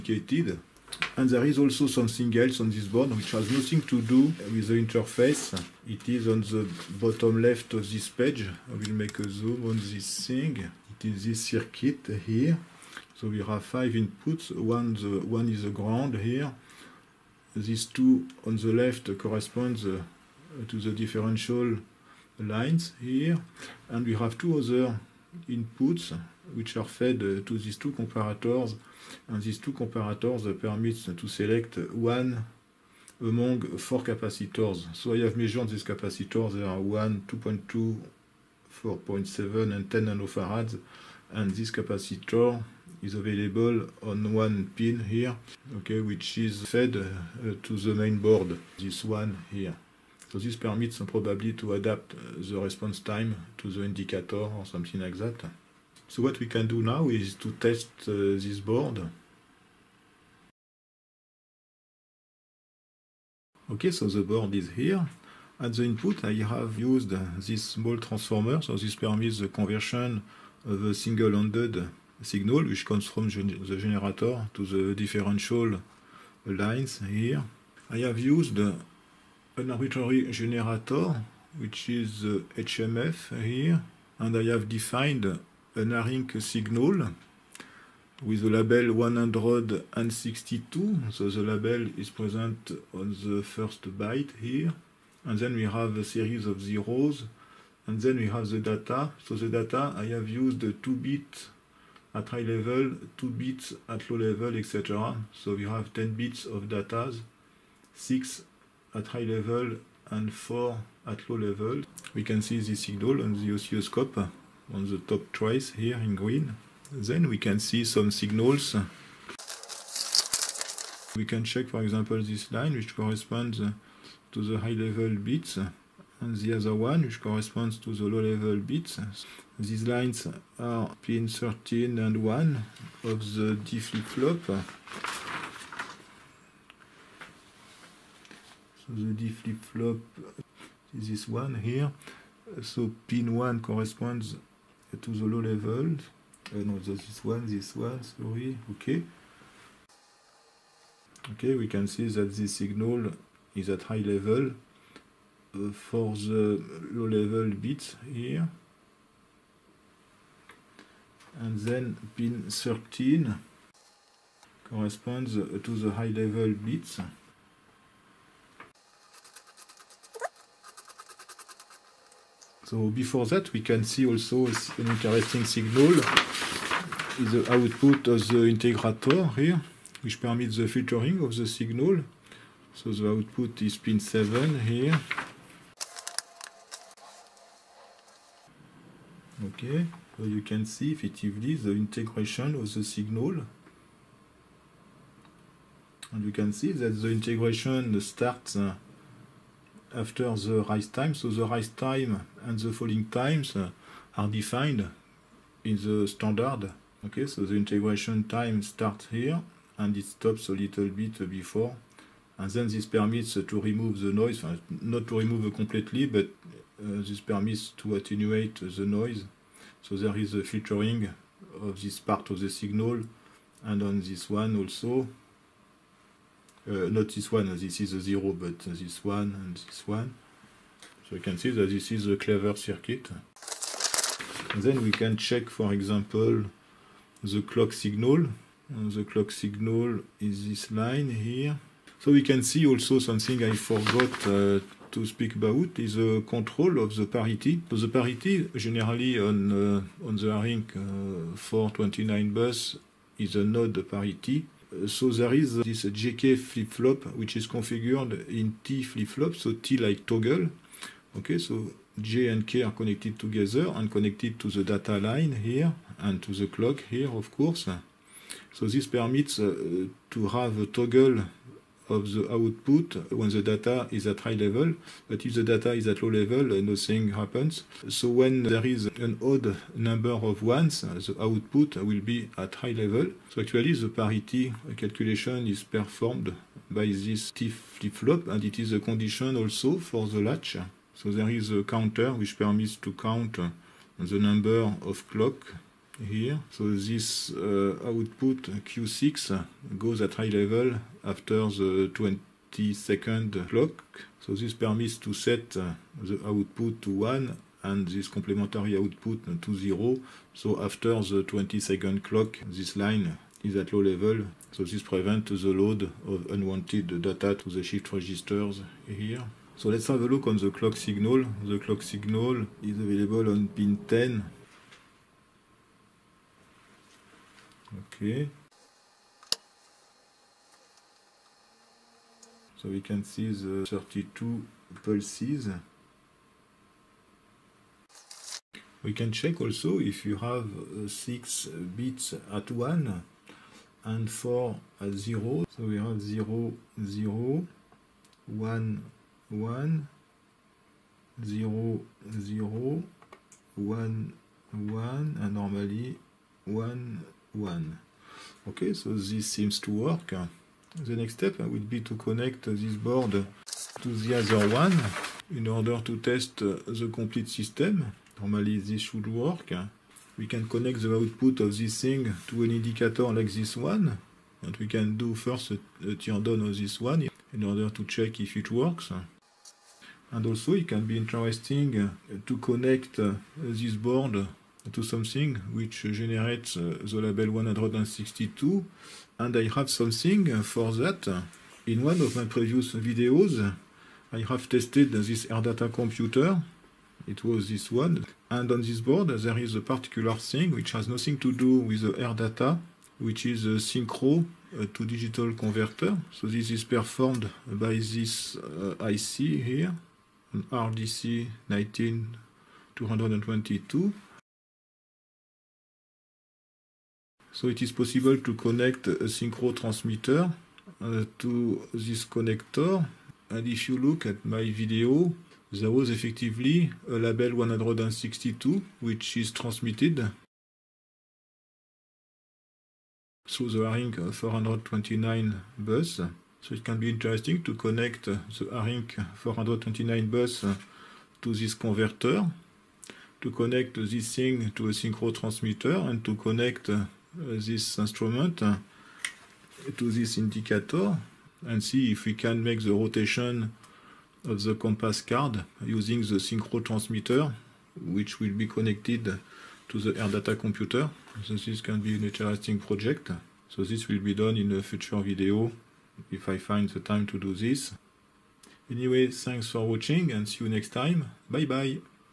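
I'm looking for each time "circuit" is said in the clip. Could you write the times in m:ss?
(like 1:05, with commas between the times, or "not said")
0:11, 3:52.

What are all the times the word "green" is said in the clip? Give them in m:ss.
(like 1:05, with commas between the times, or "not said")
1:56.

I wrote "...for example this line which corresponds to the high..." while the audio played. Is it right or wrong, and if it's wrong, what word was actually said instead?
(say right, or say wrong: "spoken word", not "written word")
right.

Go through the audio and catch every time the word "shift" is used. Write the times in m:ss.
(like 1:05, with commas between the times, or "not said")
5:17.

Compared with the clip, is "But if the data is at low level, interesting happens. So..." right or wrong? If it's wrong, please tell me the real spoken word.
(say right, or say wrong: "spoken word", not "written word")
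wrong: "nothing", not "interesting".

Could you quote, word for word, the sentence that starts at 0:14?
One, the, one is the ground here.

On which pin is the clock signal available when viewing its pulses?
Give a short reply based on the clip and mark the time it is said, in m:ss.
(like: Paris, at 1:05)
Pin 10, at 5:23.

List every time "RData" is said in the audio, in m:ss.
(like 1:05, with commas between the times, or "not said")
6:35, 6:41.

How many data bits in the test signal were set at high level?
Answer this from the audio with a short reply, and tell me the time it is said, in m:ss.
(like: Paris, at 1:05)
6, at 1:47.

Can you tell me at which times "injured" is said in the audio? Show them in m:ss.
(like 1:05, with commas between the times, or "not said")
not said.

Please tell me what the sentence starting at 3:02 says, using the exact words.
So the output is pin 7 here.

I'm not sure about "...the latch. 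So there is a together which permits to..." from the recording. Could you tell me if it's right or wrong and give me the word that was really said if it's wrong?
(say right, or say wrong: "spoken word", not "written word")
wrong: "counter", not "together".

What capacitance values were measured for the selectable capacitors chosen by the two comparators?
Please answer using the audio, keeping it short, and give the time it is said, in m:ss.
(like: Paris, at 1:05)
1, 2.2, 4.7 and 10 nF, at 0:36.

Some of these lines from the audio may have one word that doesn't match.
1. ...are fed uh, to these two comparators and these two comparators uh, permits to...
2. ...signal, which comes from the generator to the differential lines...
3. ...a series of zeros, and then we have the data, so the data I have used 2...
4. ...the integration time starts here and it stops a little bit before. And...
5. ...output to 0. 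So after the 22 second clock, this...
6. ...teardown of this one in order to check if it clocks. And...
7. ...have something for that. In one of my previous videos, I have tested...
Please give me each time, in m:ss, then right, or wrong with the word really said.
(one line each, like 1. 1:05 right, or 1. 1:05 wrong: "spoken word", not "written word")
1. 0:26 right
2. 1:12 right
3. 1:35 right
4. 3:27 right
5. 5:08 wrong: "20", not "22"
6. 6:15 wrong: "works", not "clocks"
7. 6:29 right.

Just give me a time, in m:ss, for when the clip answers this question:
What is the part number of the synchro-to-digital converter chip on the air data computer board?
6:50.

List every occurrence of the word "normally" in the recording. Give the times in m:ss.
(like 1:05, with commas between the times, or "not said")
5:55, 6:08.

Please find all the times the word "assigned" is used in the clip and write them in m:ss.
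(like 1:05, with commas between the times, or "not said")
not said.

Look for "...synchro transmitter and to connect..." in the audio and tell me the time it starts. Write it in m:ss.
7:24.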